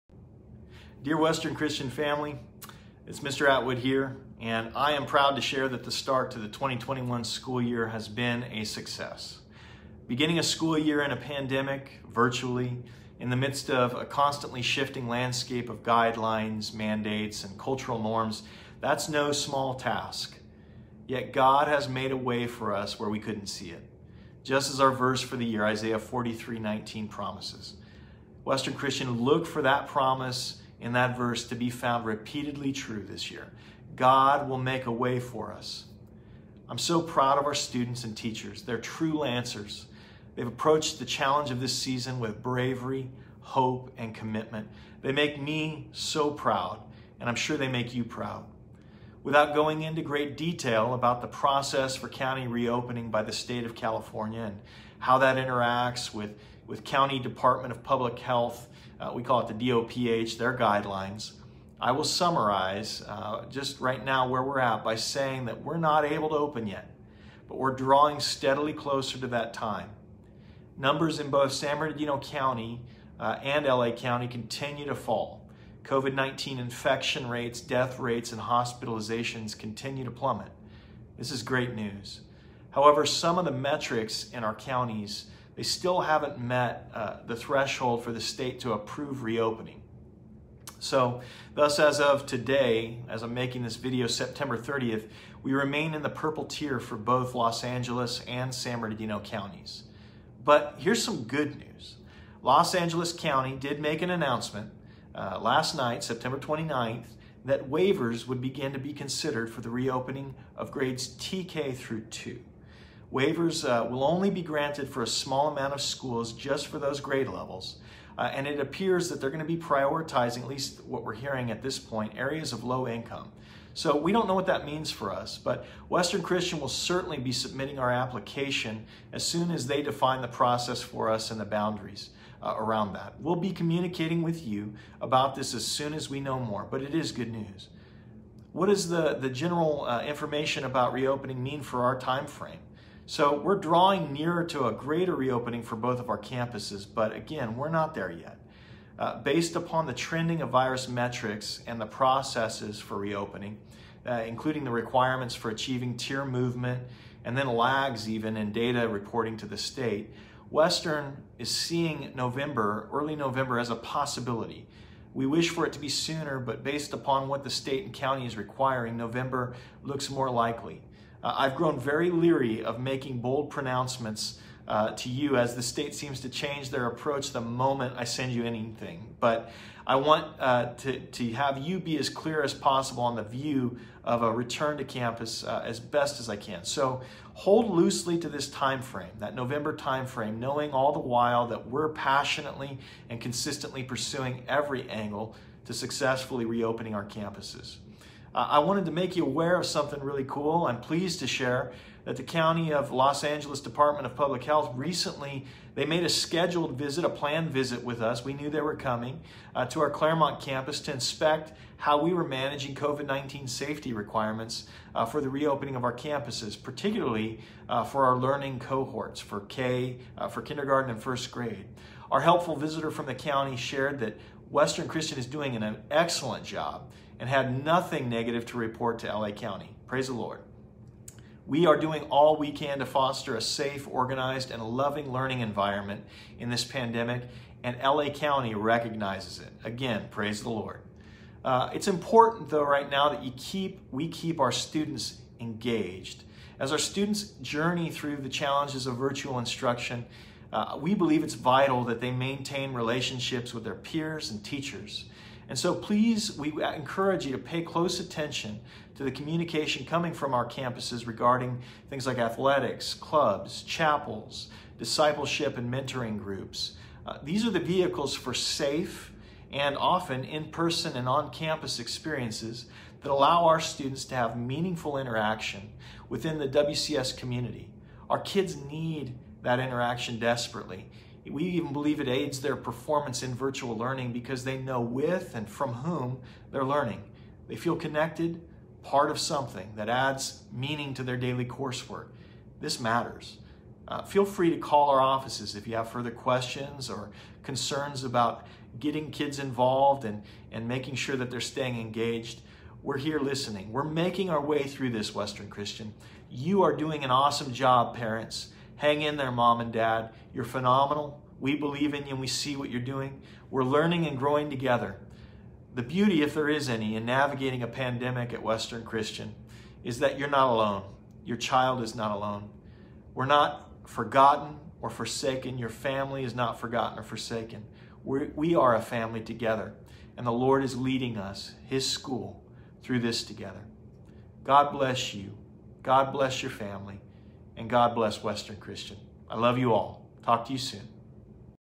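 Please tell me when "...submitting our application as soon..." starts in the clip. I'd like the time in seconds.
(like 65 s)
127 s.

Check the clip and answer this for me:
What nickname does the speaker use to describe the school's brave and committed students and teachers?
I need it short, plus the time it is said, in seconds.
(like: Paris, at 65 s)
Lancers, at 39 s.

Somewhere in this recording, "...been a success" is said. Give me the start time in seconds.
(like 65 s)
8 s.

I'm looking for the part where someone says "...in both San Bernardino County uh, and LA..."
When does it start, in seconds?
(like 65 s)
71 s.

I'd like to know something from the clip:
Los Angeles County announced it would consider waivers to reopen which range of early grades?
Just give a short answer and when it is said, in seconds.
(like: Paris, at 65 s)
TK through 2, at 111 s.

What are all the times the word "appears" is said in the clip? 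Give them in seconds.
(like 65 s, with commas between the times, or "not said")
118 s.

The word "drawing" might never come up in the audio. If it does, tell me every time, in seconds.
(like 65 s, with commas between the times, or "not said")
67 s, 143 s.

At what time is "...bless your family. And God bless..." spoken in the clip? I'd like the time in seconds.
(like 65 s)
336 s.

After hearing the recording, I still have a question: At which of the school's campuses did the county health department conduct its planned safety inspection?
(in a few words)
Claremont.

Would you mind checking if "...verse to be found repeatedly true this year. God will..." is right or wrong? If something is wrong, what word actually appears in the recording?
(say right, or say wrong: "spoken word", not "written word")
right.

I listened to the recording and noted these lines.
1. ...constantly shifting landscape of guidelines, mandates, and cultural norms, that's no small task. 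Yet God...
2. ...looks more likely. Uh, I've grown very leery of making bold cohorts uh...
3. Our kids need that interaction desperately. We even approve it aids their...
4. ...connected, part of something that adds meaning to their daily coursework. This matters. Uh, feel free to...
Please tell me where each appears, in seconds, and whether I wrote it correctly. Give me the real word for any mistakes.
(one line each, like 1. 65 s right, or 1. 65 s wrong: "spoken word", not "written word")
1. 14 s right
2. 169 s wrong: "pronouncements", not "cohorts"
3. 278 s wrong: "believe", not "approve"
4. 287 s right.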